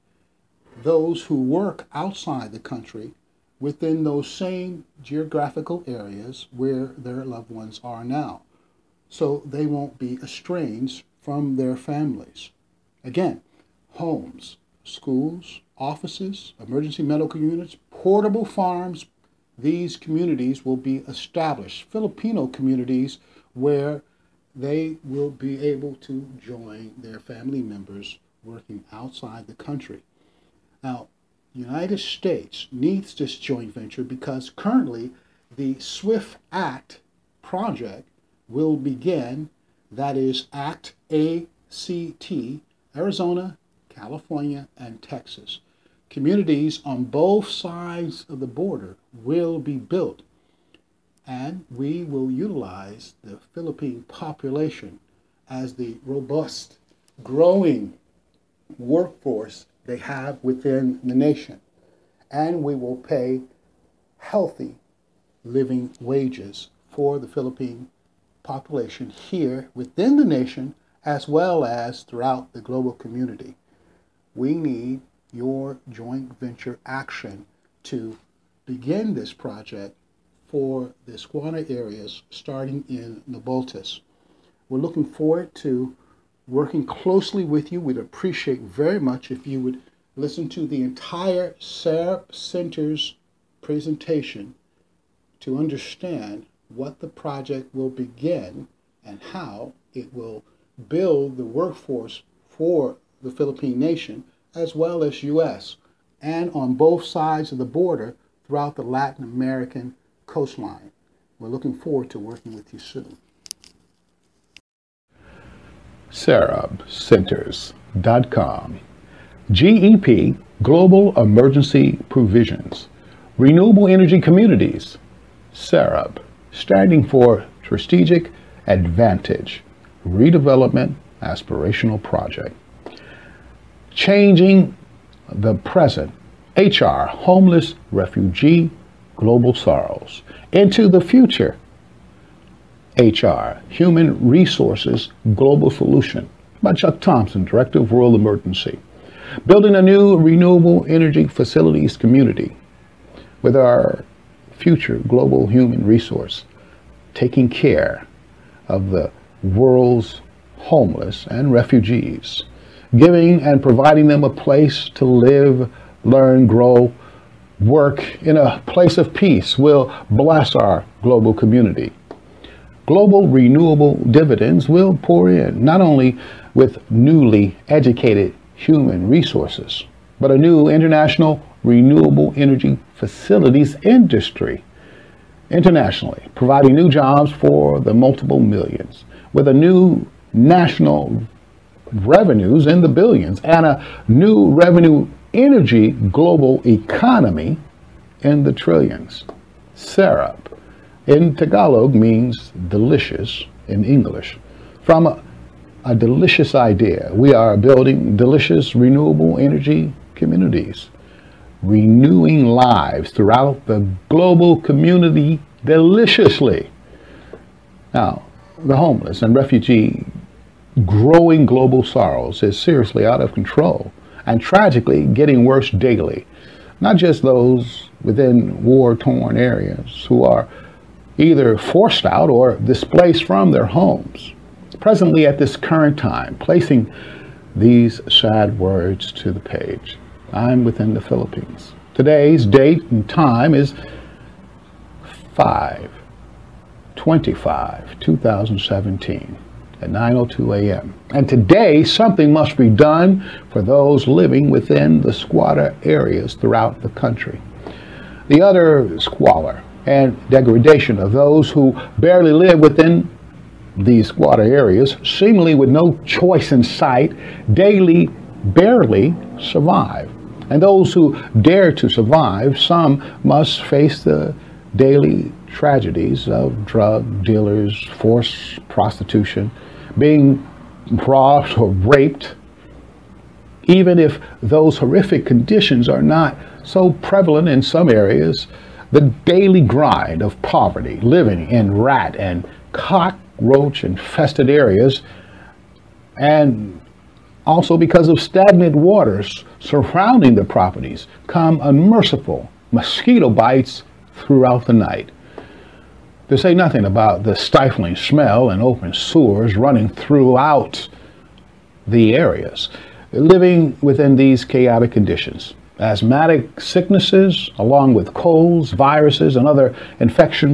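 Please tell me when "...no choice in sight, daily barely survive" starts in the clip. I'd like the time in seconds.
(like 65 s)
265 s.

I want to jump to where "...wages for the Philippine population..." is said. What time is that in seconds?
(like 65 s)
66 s.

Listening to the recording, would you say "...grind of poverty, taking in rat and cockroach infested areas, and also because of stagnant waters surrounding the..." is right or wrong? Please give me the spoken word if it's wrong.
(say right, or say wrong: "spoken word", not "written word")
wrong: "living", not "taking".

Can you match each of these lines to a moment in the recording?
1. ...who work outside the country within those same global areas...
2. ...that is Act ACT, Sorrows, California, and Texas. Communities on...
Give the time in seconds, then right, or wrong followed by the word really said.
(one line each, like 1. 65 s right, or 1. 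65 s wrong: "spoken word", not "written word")
1. 1 s wrong: "geographical", not "global"
2. 39 s wrong: "Arizona", not "Sorrows".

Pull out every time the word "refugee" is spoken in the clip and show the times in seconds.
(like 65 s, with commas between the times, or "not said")
137 s, 161 s, 219 s.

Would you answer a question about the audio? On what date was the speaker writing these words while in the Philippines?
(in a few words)
5/25/2017.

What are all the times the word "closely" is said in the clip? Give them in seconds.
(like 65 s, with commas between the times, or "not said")
86 s.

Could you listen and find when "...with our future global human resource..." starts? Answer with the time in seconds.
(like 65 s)
153 s.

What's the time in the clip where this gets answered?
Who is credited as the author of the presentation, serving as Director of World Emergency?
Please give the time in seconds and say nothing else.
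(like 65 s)
146 s.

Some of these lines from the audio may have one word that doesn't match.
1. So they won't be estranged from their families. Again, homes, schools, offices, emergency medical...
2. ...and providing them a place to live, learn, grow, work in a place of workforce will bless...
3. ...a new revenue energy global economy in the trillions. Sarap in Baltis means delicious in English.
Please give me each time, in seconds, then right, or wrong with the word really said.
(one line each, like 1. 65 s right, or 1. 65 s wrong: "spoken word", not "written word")
1. 9 s right
2. 163 s wrong: "peace", not "workforce"
3. 193 s wrong: "Tagalog", not "Baltis".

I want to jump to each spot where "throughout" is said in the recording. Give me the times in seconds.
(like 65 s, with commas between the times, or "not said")
72 s, 108 s, 213 s, 256 s, 304 s, 309 s.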